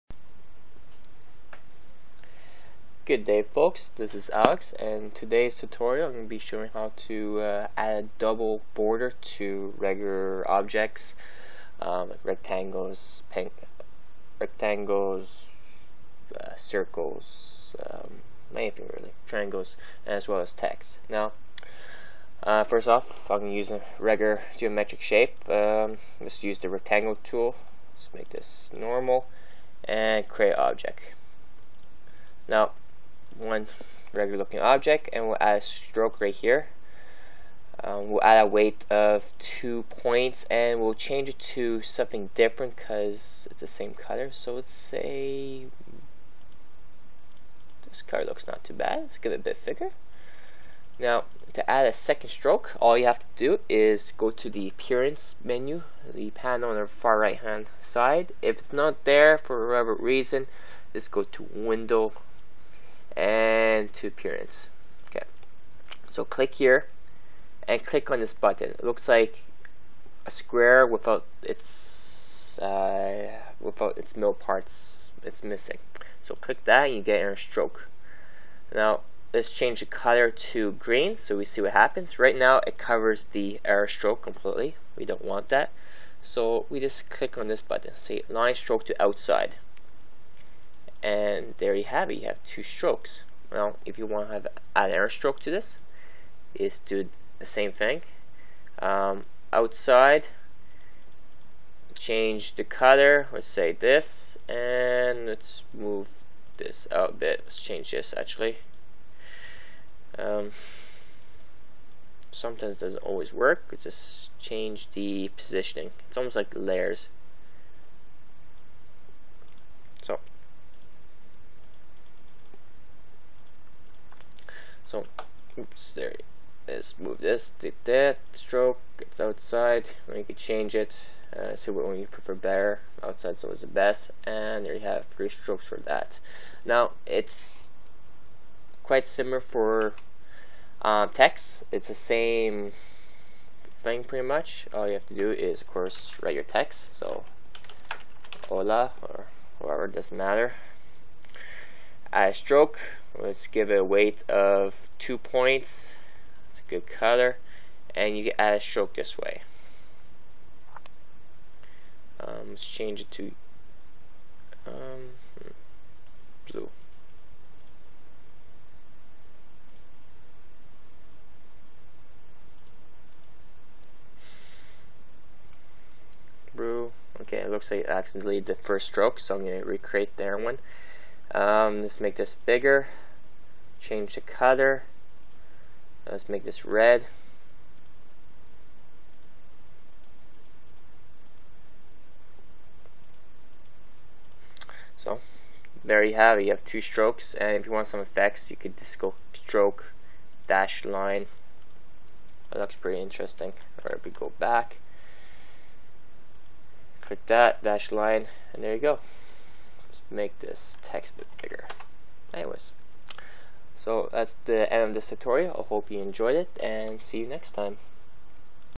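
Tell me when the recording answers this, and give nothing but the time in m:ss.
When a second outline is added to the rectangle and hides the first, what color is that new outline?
1:20.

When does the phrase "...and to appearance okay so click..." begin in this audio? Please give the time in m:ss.
1:03.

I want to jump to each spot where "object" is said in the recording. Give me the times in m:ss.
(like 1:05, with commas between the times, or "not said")
0:10, 0:30, 0:34.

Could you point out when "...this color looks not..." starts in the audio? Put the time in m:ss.
0:47.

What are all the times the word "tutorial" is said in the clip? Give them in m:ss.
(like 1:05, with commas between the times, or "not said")
0:05, 3:35.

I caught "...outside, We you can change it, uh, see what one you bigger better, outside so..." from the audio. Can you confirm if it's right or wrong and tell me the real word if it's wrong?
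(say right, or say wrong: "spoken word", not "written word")
wrong: "prefer", not "bigger".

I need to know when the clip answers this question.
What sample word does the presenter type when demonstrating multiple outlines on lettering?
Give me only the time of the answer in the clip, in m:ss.
2:28.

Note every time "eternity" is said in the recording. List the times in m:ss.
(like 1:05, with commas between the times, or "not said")
not said.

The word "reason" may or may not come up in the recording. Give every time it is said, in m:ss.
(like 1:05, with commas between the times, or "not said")
0:59.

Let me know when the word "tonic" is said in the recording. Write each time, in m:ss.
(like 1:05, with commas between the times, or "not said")
not said.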